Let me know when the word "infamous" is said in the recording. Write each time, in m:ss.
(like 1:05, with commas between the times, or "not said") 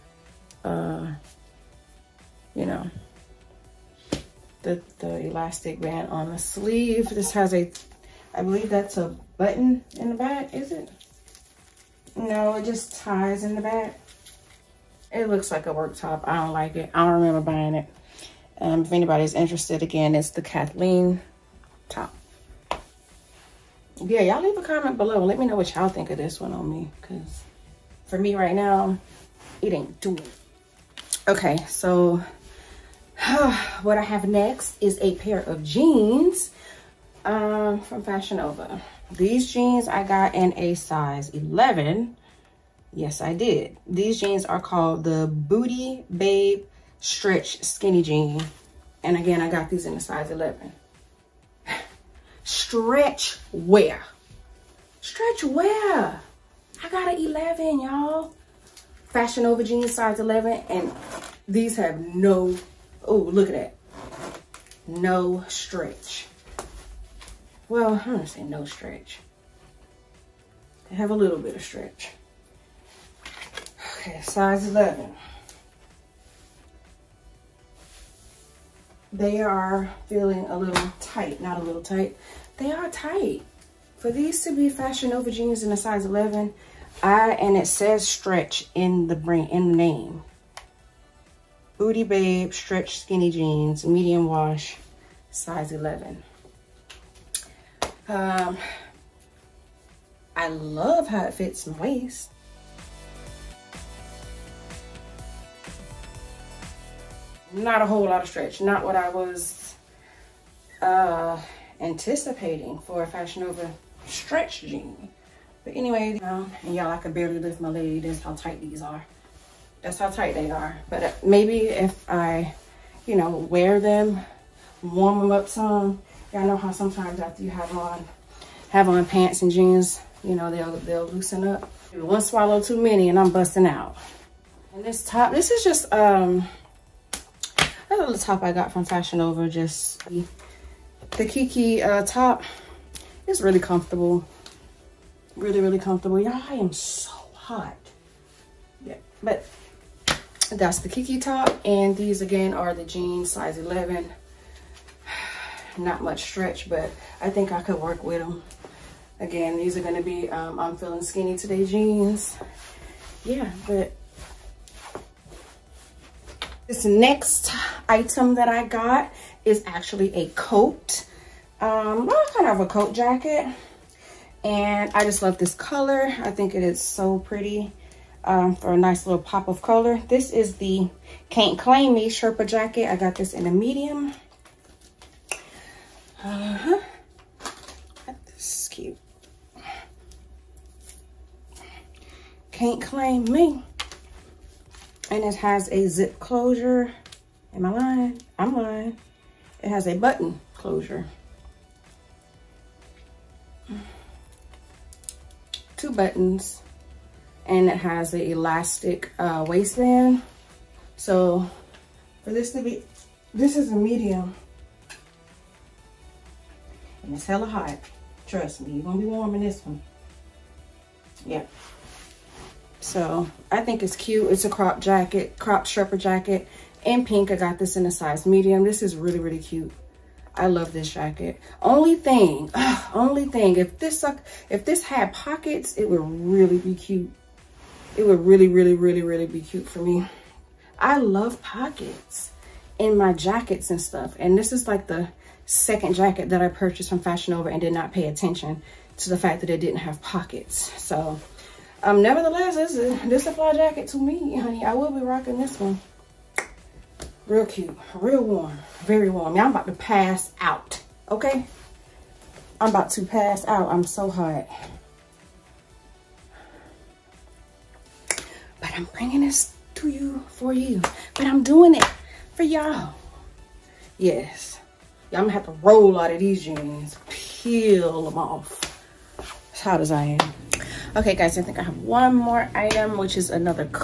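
not said.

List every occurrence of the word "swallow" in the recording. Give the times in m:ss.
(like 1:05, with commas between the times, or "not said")
2:12.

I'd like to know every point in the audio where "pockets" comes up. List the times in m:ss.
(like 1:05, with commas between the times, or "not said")
3:55, 4:01, 4:10.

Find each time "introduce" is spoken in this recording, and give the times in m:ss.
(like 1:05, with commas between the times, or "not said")
not said.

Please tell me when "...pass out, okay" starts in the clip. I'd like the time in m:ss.
4:19.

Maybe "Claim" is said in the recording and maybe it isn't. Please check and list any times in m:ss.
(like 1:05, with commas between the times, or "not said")
3:01, 3:12.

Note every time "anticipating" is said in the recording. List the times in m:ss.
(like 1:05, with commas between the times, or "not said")
1:51.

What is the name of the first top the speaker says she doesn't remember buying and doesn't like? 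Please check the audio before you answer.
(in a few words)
Kathleen top.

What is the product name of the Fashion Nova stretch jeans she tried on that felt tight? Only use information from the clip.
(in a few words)
Booty Babe Stretch Skinny Jean.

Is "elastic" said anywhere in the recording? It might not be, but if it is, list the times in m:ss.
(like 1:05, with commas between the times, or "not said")
0:05, 3:28.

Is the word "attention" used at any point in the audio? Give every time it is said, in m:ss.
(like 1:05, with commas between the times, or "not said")
4:08.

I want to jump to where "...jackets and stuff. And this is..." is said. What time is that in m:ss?
4:03.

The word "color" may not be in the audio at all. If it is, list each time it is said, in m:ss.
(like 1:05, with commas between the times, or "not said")
2:55, 2:59.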